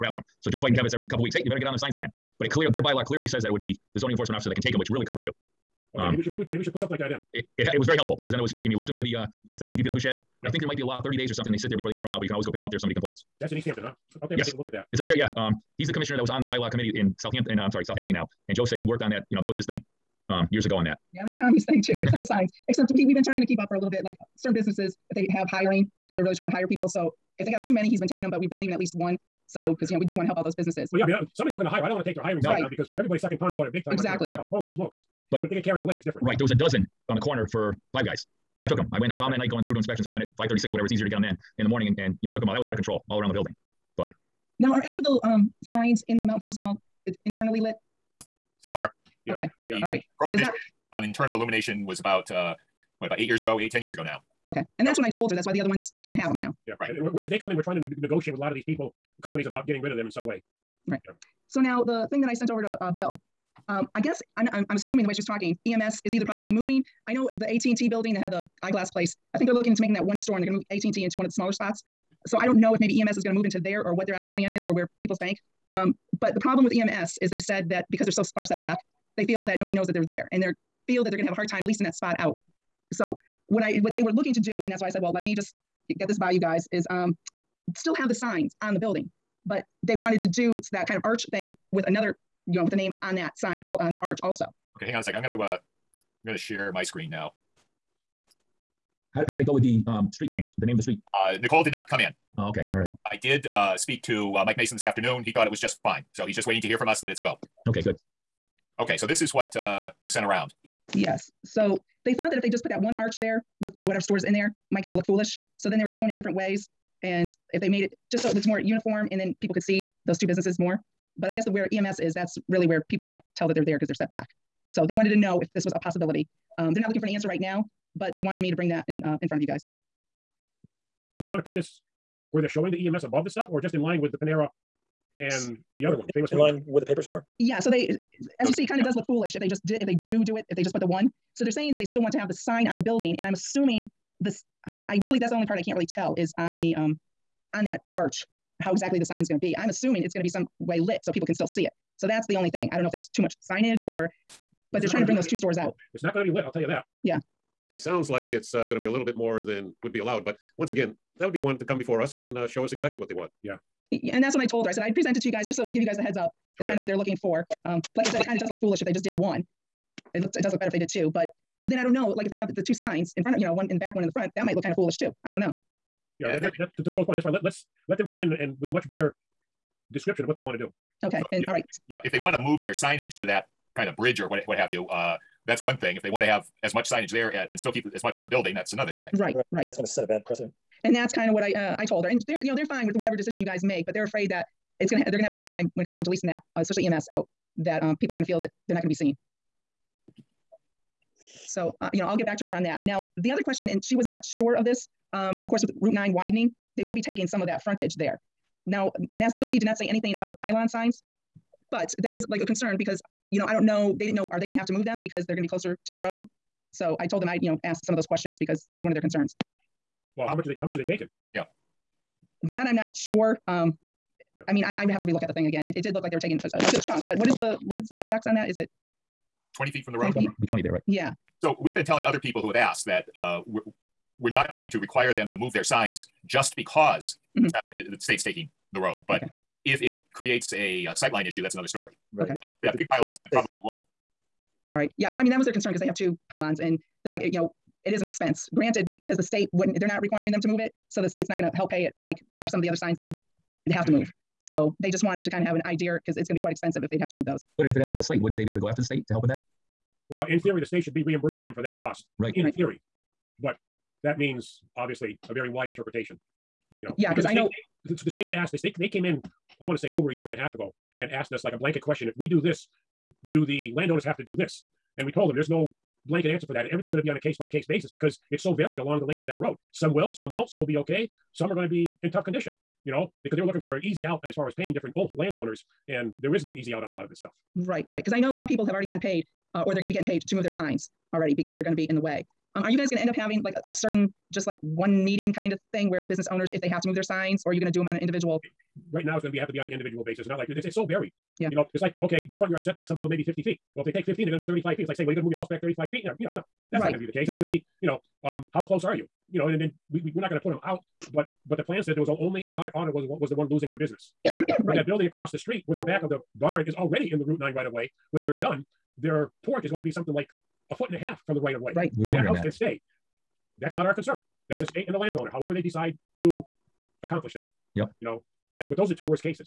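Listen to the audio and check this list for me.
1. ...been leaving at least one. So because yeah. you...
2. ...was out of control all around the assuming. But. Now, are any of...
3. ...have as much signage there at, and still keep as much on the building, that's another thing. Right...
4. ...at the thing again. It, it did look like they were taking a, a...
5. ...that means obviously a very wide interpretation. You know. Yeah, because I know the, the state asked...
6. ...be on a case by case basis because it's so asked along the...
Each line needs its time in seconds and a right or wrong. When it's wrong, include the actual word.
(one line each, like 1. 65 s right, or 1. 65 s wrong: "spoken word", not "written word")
1. 28 s right
2. 42 s wrong: "building", not "assuming"
3. 186 s right
4. 225 s right
5. 264 s right
6. 277 s wrong: "varied", not "asked".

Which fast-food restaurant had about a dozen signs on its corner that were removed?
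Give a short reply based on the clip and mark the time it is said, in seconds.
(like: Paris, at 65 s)
Five Guys, at 37 s.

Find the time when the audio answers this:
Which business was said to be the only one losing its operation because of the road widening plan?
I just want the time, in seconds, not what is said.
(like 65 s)
312 s.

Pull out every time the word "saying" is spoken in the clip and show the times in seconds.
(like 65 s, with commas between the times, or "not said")
141 s, 304 s.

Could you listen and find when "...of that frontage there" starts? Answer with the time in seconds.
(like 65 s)
207 s.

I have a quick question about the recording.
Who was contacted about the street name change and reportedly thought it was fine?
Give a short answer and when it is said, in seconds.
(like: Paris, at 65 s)
Mike Mason, at 104 s.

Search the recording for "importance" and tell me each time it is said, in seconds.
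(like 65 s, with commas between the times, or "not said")
not said.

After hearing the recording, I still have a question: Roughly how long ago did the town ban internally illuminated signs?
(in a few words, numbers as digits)
8 to 10 years.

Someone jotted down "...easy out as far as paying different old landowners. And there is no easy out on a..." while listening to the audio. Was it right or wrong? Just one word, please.
right.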